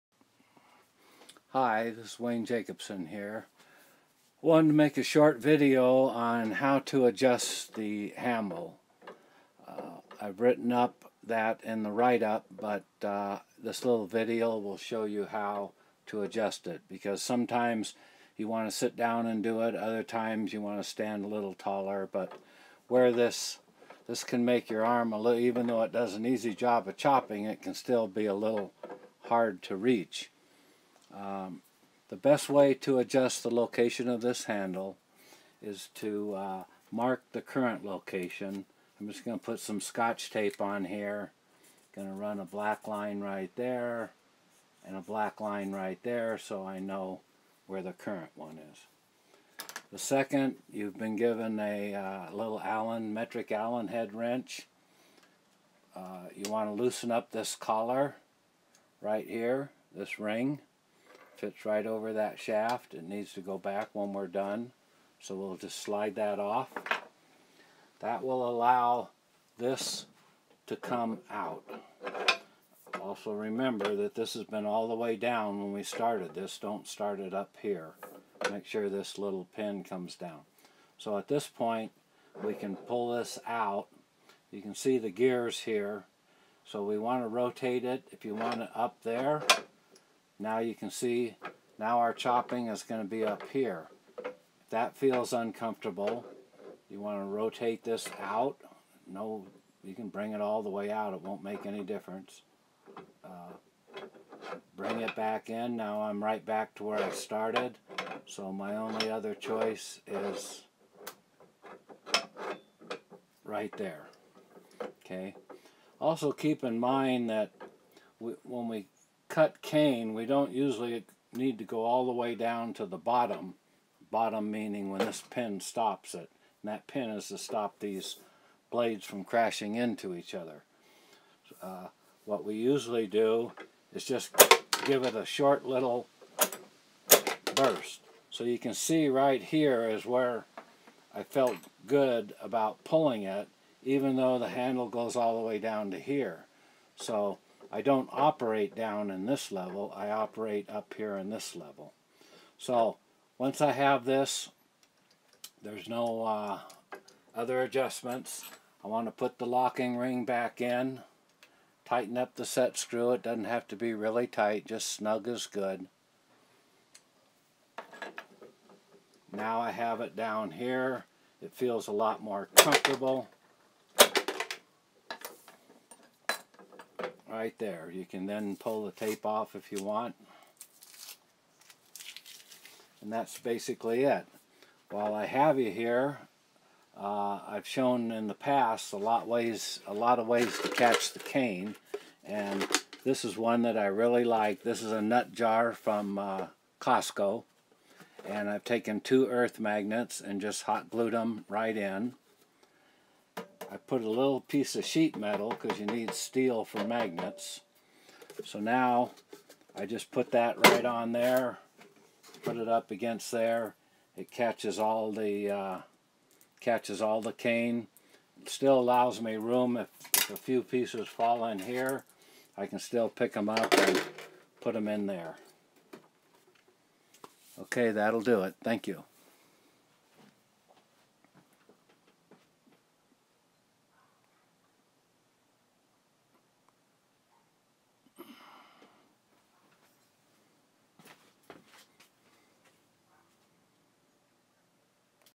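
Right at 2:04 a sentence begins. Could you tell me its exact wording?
Bottom meaning when this pin stops it.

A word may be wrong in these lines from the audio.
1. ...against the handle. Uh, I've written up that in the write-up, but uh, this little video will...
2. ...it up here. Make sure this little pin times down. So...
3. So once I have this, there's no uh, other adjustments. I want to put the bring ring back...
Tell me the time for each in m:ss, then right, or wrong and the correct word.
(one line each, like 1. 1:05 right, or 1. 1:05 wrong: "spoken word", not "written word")
1. 0:07 wrong: "adjust", not "against"
2. 1:17 wrong: "comes", not "times"
3. 2:32 wrong: "locking", not "bring".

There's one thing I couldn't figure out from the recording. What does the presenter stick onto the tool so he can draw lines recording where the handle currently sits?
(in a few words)
Scotch tape.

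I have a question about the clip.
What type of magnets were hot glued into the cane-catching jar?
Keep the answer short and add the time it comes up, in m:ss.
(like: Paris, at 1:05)
Earth magnets, at 3:19.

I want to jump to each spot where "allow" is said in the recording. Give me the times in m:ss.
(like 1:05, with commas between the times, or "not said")
1:08, 3:38.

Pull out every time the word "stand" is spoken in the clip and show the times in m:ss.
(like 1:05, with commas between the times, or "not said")
0:20.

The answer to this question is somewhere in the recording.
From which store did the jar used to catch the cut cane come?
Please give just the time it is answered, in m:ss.
3:16.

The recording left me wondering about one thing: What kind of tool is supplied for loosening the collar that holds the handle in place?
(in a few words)
Metric Allen head wrench.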